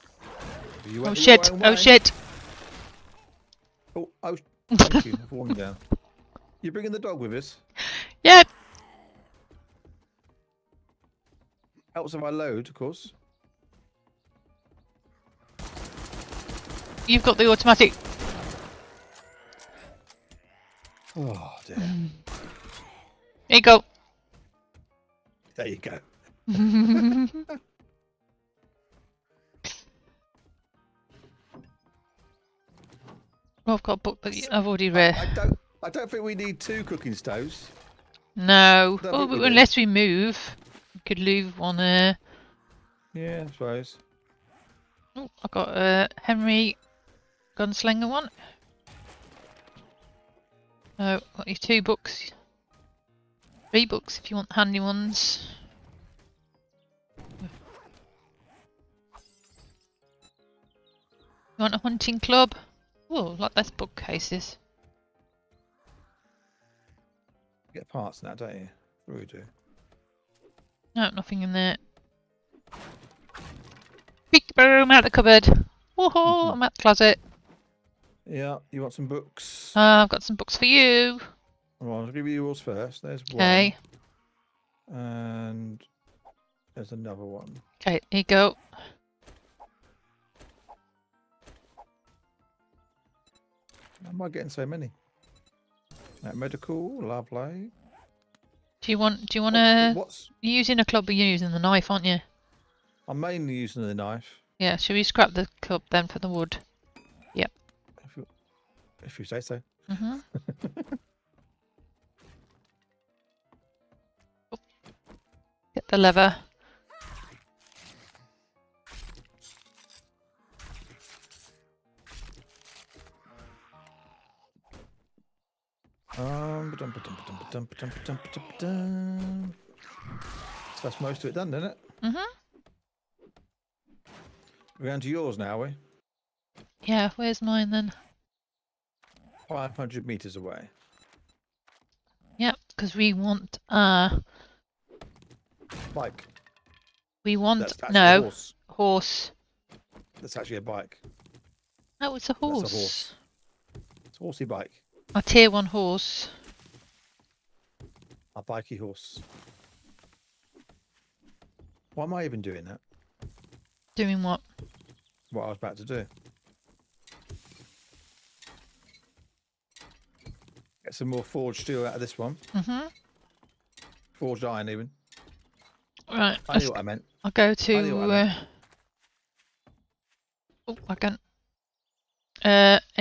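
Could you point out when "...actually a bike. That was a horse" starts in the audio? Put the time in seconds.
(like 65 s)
150 s.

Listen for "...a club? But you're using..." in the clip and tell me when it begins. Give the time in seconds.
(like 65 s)
100 s.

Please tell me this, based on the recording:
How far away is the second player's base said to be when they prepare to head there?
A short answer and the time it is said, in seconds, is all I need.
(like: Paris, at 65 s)
500 meters, at 139 s.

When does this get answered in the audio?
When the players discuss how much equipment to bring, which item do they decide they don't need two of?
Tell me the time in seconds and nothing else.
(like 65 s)
36 s.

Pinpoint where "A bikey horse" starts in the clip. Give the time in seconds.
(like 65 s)
158 s.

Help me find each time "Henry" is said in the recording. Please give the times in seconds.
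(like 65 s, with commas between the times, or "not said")
46 s.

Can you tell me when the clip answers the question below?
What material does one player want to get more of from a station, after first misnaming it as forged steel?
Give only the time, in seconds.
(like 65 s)
174 s.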